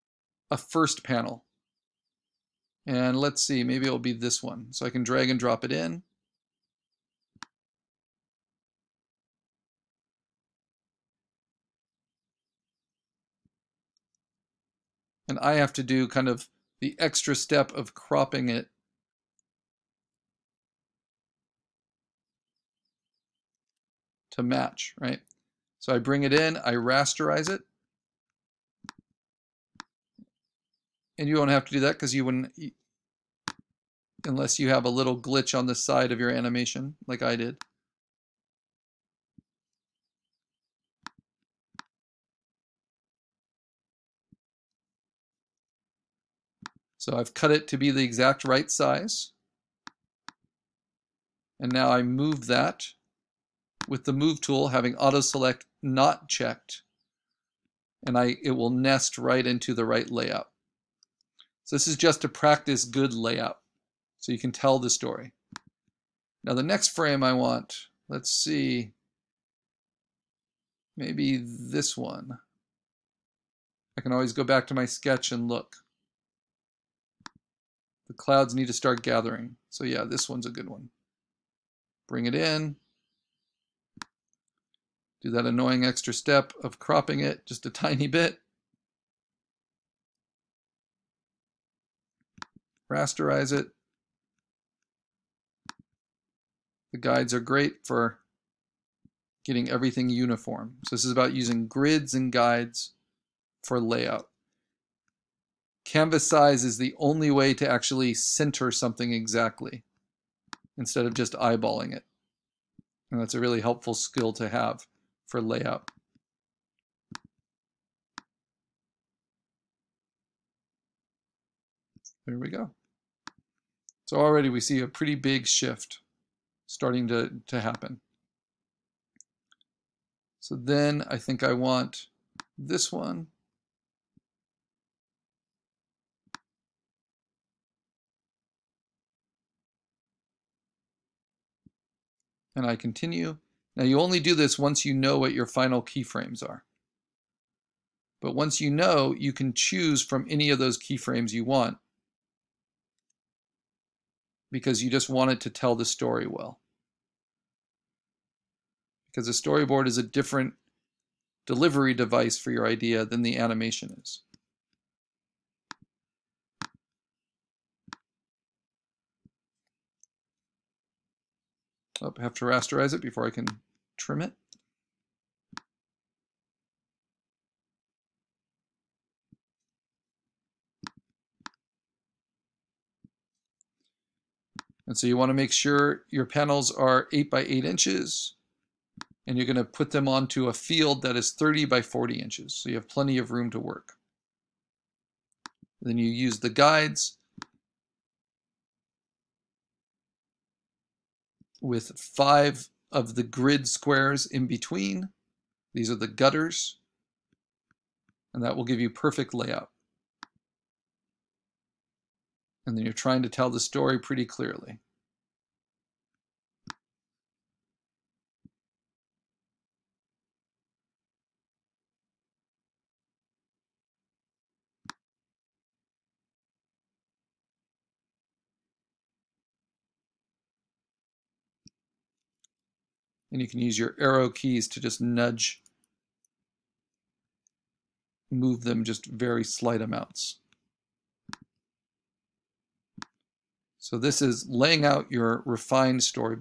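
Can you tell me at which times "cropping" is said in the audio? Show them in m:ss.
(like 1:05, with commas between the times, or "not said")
0:17, 1:26.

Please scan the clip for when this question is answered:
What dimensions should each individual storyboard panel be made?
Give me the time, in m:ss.
3:07.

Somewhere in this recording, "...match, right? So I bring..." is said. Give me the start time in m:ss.
0:24.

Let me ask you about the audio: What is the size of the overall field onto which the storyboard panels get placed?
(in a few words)
30 by 40 inches.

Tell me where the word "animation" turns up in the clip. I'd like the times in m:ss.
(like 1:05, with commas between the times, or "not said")
0:36, 2:43.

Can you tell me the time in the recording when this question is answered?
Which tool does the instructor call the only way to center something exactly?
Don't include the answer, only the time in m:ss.
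1:45.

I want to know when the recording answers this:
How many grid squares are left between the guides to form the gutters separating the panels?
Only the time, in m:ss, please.
3:21.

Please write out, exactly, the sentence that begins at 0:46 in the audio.
So I've cut it to be the exact right size.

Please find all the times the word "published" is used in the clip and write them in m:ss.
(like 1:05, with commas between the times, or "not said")
not said.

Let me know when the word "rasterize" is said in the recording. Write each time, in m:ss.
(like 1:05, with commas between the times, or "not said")
0:26, 1:32, 2:52.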